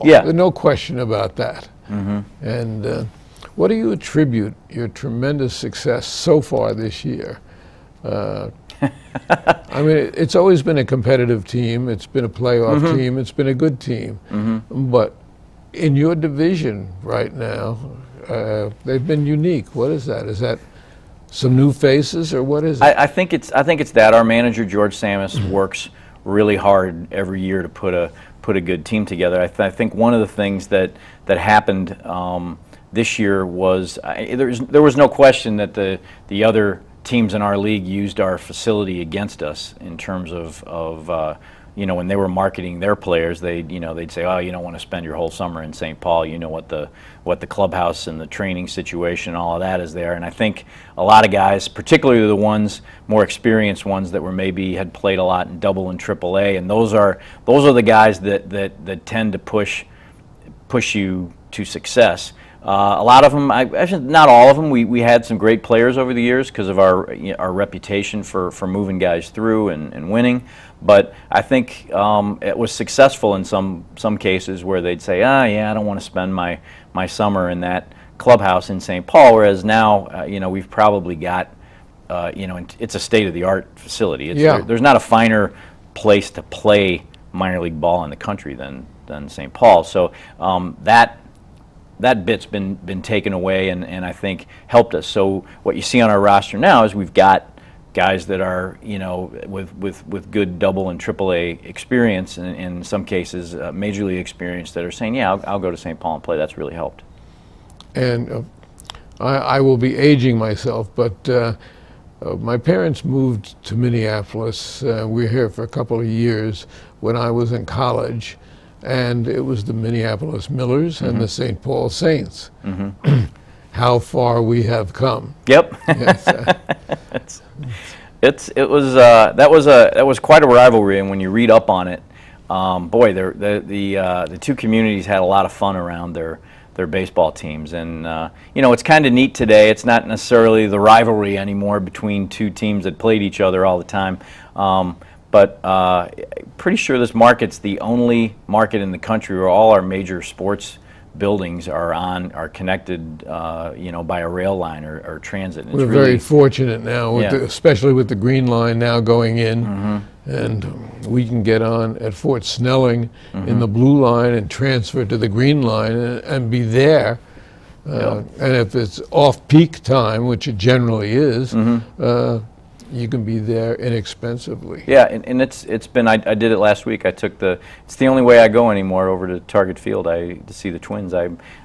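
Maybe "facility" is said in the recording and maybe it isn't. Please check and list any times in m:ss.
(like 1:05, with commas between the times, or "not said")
0:38, 1:23.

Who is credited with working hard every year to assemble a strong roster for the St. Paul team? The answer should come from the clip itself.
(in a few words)
George Tsamis.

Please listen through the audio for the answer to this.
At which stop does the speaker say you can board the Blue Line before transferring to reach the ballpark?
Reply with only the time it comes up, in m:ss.
2:42.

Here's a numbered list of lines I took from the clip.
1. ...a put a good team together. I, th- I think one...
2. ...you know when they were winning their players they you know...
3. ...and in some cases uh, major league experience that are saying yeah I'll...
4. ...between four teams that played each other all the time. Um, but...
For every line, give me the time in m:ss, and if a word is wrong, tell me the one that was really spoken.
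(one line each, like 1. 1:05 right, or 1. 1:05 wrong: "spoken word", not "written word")
1. 0:27 right
2. 0:41 wrong: "marketing", not "winning"
3. 1:42 right
4. 2:21 wrong: "two", not "four".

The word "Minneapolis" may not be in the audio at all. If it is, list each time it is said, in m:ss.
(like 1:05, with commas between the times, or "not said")
1:53, 1:59.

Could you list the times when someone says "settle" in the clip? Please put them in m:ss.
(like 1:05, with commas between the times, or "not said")
not said.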